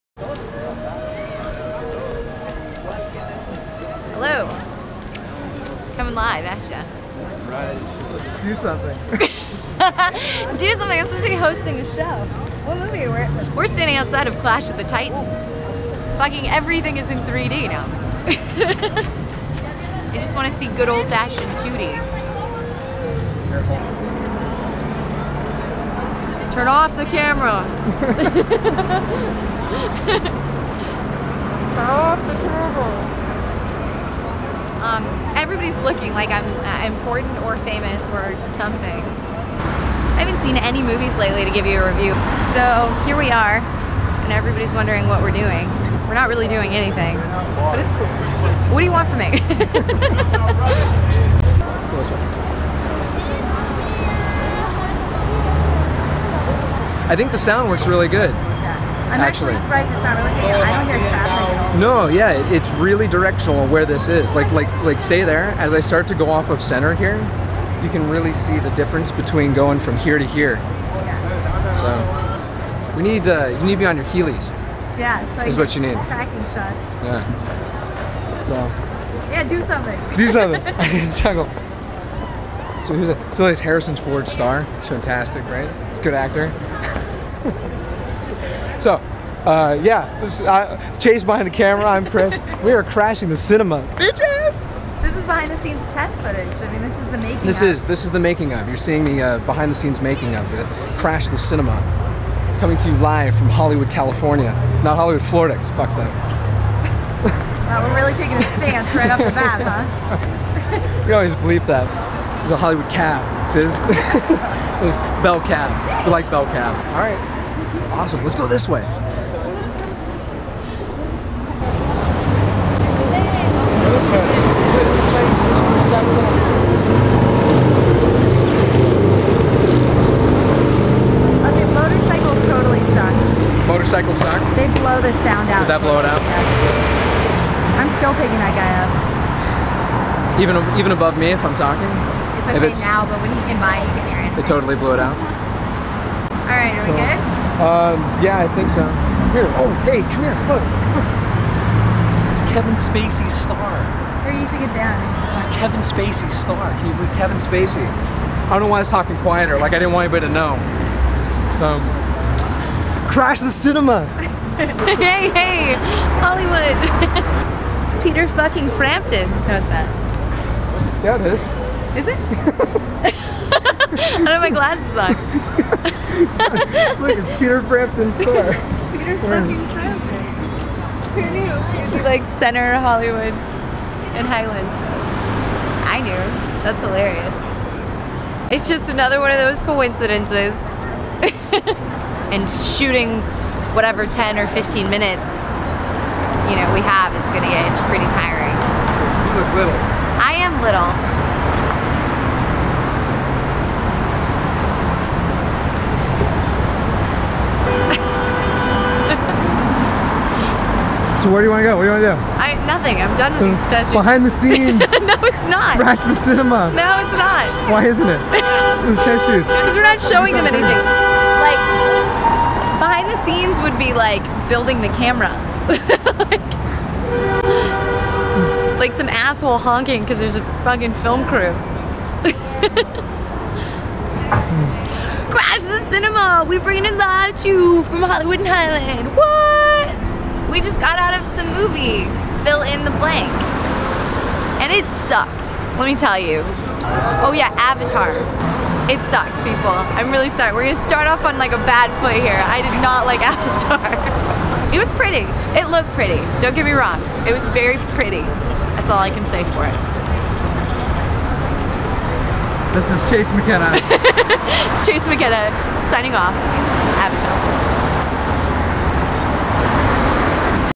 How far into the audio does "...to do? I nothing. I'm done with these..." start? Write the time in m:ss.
3:32.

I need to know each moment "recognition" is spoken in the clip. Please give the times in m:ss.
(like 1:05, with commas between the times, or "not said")
not said.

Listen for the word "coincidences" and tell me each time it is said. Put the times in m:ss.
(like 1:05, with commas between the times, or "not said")
3:09.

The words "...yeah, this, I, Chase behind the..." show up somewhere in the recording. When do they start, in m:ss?
1:29.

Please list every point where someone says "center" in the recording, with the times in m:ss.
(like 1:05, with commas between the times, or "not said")
1:06, 3:02.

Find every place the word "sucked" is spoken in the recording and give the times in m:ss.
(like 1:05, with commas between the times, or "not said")
4:05, 4:09.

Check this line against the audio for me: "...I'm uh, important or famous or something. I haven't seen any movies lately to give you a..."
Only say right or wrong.
right.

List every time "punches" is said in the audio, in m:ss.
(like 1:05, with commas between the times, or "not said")
not said.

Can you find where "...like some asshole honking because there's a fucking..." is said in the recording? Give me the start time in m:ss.
3:48.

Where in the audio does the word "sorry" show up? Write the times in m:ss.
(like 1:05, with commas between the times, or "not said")
4:10.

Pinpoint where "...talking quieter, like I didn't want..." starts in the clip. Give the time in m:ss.
2:38.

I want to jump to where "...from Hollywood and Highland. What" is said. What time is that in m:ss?
3:57.